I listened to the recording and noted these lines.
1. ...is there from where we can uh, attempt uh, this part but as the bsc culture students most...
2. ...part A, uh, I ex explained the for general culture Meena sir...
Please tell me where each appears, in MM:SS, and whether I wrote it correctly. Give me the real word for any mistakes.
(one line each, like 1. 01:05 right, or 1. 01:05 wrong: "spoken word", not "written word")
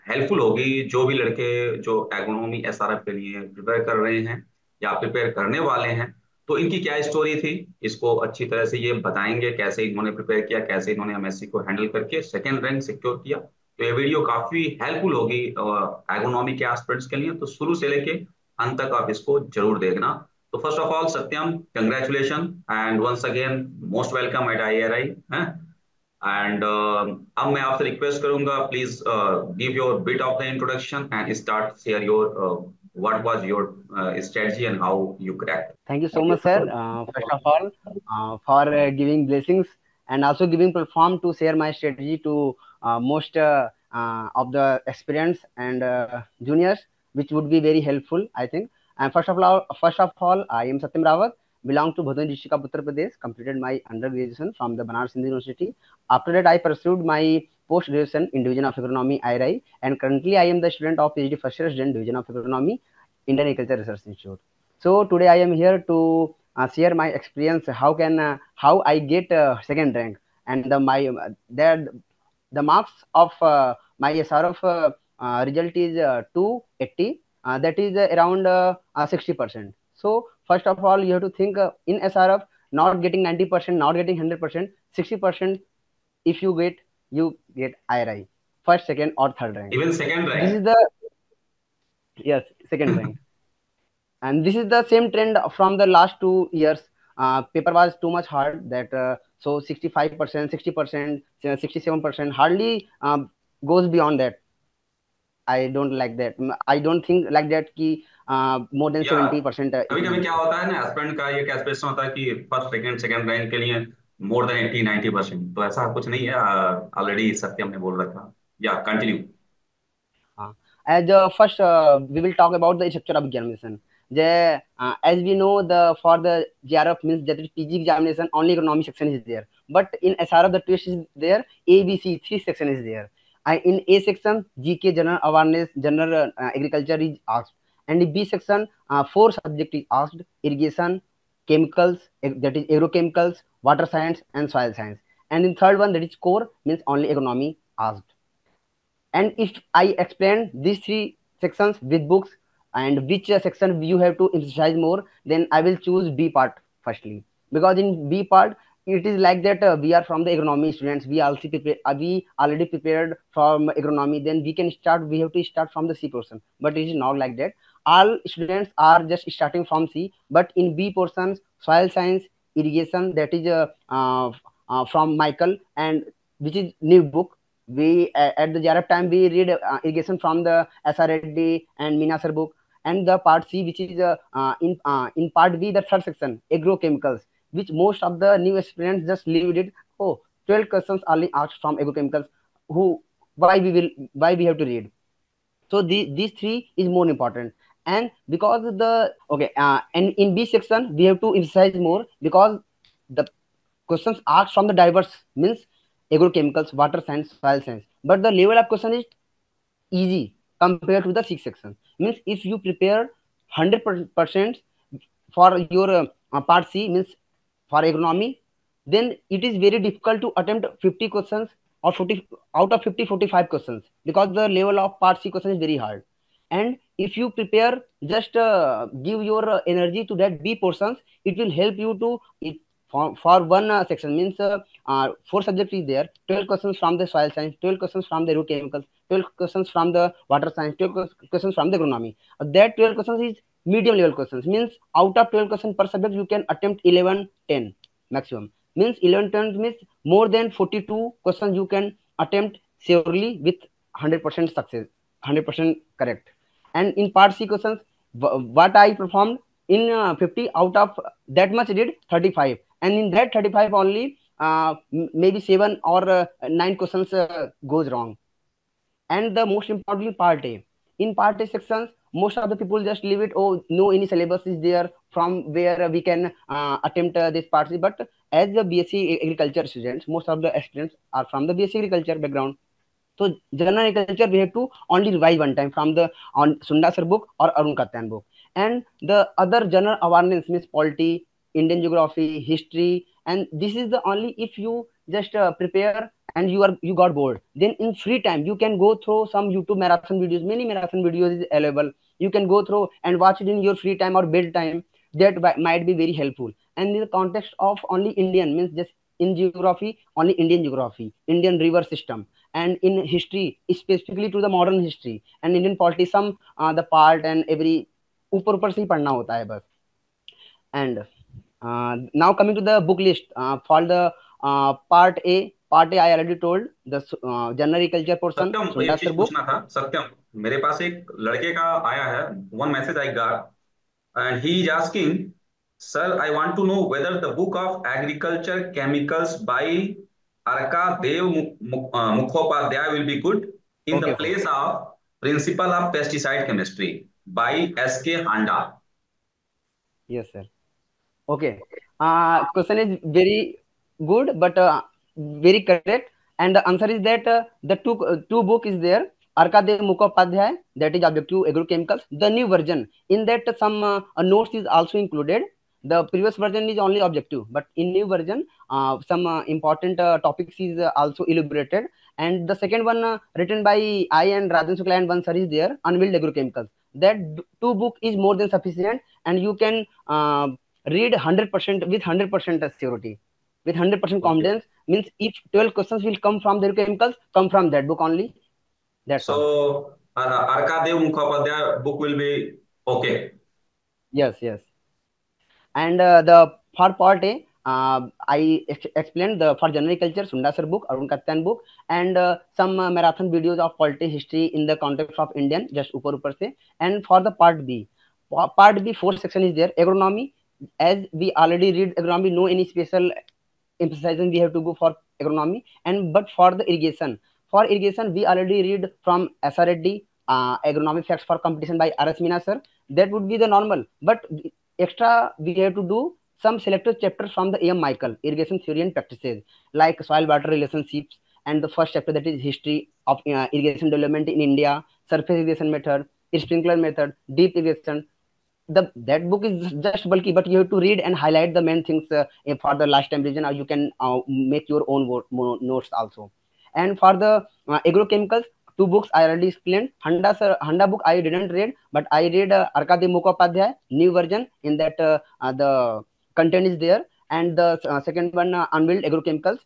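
1. 04:34 wrong: "agriculture", not "culture"
2. 06:37 wrong: "Sundar", not "Meena".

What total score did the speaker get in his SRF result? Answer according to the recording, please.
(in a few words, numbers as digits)
280.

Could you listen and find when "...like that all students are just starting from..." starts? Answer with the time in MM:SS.
02:47.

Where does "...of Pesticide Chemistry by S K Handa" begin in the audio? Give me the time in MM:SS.
05:45.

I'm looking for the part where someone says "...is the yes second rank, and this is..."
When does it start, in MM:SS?
01:30.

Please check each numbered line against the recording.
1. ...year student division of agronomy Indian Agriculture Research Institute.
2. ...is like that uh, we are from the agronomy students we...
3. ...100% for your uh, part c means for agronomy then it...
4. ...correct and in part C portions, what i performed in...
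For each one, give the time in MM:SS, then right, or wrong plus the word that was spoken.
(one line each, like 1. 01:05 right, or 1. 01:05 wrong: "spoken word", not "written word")
1. 01:01 right
2. 02:39 right
3. 03:33 right
4. 04:16 wrong: "questions", not "portions".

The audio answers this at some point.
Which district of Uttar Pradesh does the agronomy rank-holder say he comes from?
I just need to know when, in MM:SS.
00:52.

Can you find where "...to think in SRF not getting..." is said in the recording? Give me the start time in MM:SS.
01:21.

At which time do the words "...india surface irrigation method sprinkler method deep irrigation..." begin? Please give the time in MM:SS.
07:14.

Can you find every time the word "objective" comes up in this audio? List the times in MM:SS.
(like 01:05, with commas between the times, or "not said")
06:01, 06:07.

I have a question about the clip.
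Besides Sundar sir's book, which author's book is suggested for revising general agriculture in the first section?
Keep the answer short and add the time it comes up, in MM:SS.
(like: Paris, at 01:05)
Arun Katyan, at 04:47.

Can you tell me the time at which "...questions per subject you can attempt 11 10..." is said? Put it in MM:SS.
04:05.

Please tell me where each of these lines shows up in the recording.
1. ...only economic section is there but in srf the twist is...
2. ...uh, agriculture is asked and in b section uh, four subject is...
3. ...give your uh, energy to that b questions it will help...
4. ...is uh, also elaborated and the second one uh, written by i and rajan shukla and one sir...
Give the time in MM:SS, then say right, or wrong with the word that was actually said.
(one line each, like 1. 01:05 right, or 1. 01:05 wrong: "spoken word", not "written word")
1. 02:08 right
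2. 02:16 right
3. 03:49 wrong: "portions", not "questions"
4. 06:10 right.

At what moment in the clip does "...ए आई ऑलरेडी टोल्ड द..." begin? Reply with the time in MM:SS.
05:25.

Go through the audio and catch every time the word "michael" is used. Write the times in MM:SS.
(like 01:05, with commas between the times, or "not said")
02:55, 07:07.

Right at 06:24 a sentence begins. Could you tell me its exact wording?
confidence means if 12 questions will come from the chemicals come from that book only that's so all.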